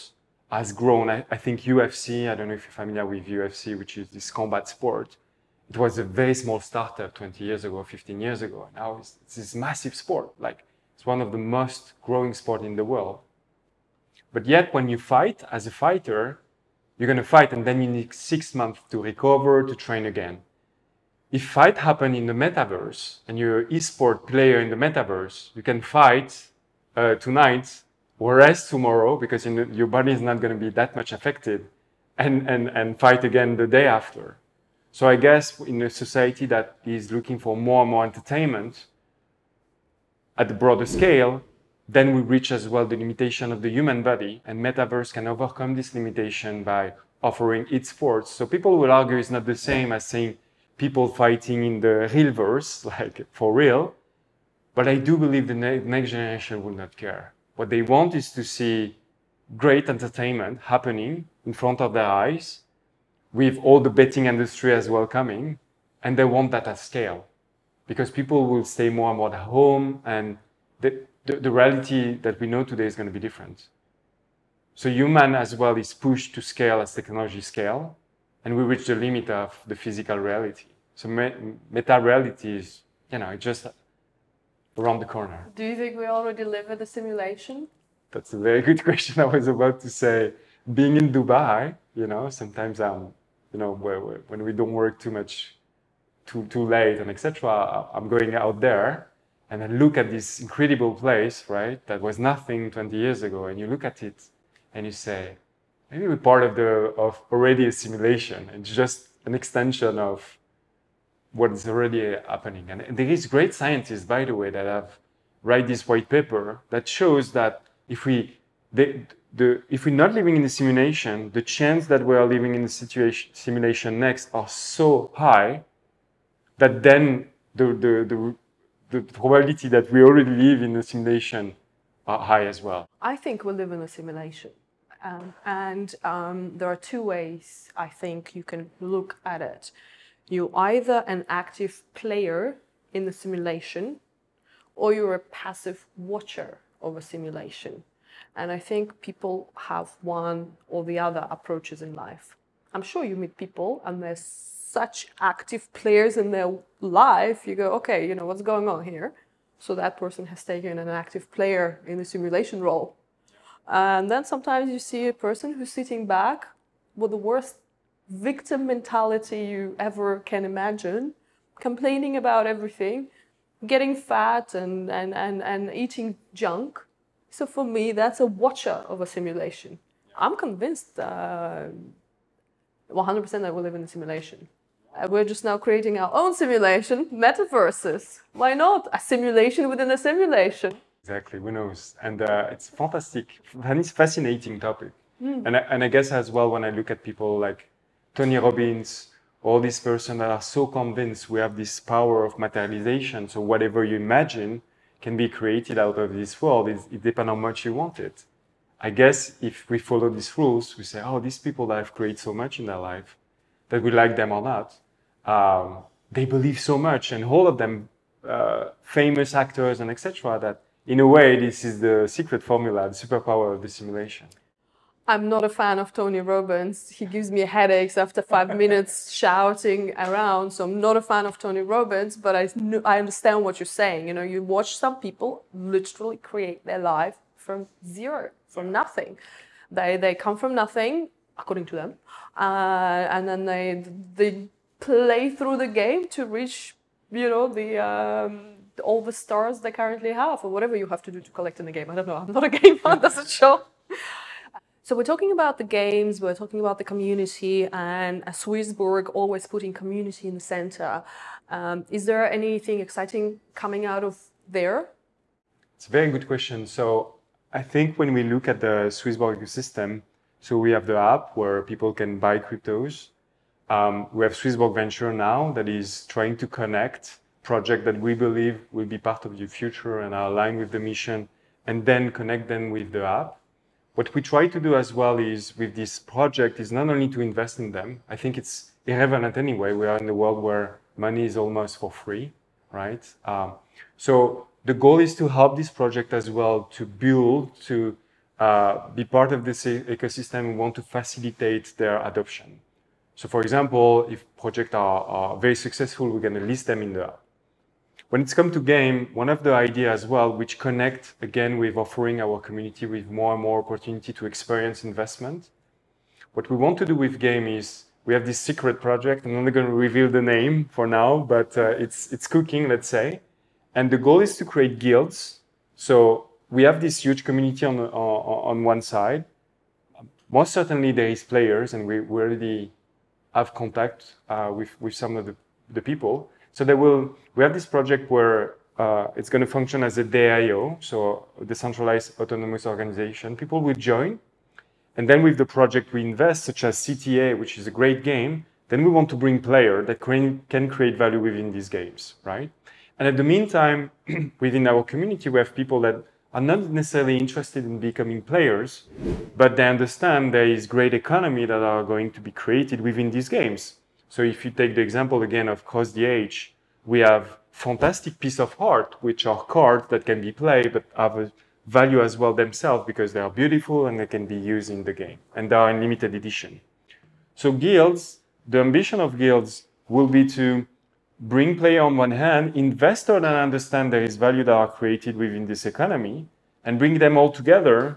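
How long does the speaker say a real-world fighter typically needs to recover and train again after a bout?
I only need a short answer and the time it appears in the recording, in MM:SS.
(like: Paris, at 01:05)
6 months, at 00:18.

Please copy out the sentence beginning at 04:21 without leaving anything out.
Um, is there anything exciting coming out of there?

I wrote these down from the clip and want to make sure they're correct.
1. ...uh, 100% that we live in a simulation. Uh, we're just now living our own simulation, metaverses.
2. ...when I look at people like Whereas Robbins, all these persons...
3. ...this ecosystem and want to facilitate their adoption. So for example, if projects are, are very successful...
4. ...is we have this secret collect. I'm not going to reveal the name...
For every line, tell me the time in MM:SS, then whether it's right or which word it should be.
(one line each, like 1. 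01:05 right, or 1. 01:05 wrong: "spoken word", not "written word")
1. 03:00 wrong: "creating", not "living"
2. 03:16 wrong: "Tony", not "Whereas"
3. 04:59 right
4. 05:17 wrong: "project", not "collect".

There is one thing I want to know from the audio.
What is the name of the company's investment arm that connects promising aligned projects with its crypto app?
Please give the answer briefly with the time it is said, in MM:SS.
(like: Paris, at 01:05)
Swissborg Venture, at 04:34.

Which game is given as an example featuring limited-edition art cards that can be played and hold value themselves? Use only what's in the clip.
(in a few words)
Cross the Ages.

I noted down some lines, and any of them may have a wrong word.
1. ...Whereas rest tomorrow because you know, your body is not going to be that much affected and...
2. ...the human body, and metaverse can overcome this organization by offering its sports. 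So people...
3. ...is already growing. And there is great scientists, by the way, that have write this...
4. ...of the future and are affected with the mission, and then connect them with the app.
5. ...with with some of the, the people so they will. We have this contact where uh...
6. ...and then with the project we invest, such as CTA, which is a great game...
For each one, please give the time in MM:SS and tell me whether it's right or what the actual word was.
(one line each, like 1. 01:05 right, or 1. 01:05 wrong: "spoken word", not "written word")
1. 00:28 right
2. 00:43 wrong: "limitation", not "organization"
3. 01:51 wrong: "happening", not "growing"
4. 04:39 wrong: "aligned", not "affected"
5. 05:34 wrong: "project", not "contact"
6. 05:44 right.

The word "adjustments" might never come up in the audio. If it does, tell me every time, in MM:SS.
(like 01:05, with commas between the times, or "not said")
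not said.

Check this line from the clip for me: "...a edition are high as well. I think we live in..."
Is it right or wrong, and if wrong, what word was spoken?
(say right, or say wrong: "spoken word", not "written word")
wrong: "simulation", not "edition".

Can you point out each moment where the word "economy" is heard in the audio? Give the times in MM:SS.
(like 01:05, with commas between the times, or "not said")
06:00, 06:25.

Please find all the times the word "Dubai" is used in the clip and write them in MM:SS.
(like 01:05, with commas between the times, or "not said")
01:31.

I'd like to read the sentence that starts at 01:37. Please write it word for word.
I'm going out there, and I look at this incredible place, right?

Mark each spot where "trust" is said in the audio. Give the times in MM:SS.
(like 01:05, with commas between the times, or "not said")
not said.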